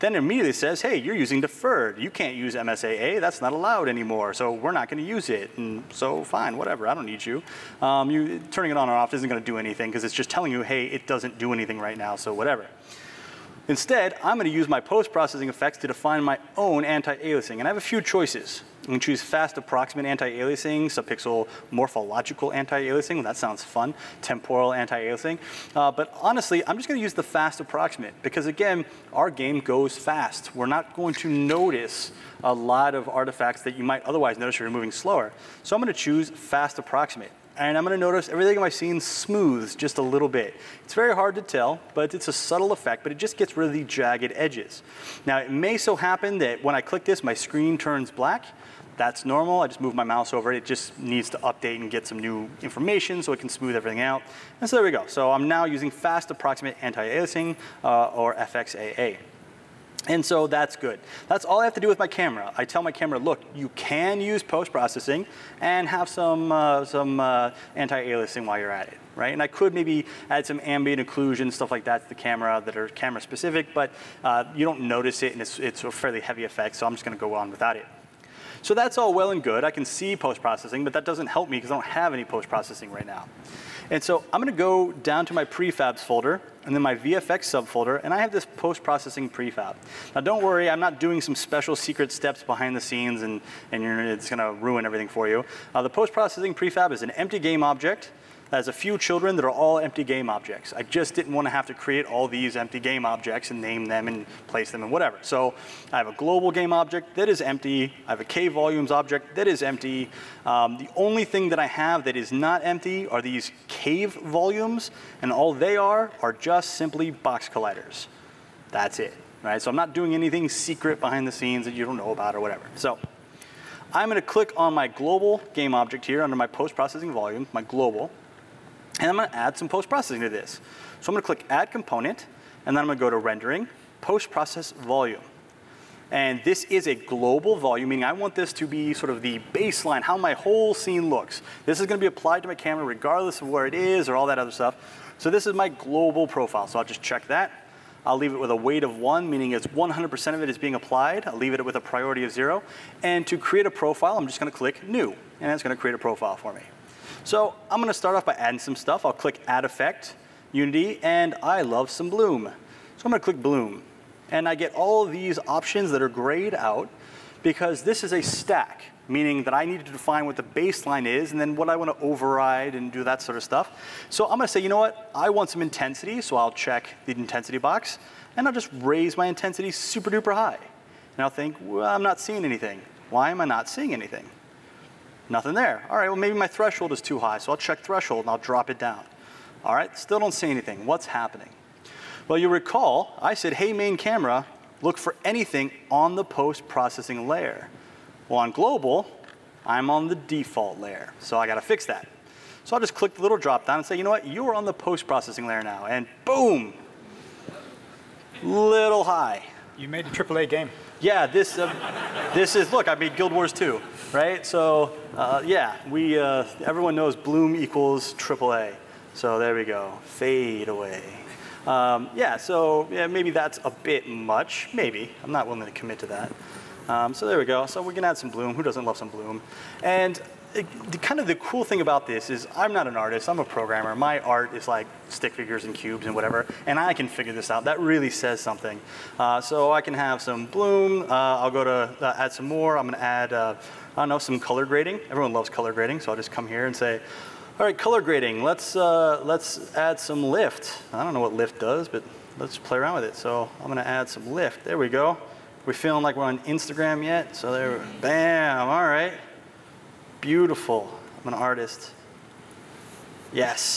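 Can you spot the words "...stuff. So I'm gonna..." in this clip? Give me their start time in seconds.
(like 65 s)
173 s.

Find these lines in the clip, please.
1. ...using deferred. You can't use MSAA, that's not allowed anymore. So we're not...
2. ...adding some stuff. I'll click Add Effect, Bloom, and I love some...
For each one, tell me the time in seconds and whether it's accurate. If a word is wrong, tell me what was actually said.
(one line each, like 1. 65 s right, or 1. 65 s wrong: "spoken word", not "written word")
1. 1 s right
2. 158 s wrong: "Unity", not "Bloom".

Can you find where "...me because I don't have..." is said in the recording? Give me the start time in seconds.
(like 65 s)
81 s.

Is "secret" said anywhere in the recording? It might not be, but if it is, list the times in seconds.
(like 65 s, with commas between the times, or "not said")
91 s, 120 s.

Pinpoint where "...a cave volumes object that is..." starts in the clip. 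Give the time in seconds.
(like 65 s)
108 s.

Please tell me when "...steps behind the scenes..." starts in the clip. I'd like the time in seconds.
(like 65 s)
92 s.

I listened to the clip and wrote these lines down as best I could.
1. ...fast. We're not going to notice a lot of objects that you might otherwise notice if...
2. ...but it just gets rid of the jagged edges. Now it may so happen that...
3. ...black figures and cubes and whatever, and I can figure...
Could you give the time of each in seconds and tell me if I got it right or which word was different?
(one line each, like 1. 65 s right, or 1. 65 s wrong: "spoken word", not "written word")
1. 29 s wrong: "artifacts", not "objects"
2. 43 s right
3. 235 s wrong: "stick", not "black".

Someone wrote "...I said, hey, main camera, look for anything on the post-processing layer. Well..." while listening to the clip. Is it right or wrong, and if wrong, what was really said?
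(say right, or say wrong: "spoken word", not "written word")
right.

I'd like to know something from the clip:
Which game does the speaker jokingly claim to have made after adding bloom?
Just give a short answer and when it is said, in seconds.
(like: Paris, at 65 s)
Guild Wars 2, at 213 s.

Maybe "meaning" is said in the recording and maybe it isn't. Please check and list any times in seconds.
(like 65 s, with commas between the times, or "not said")
137 s, 149 s, 169 s.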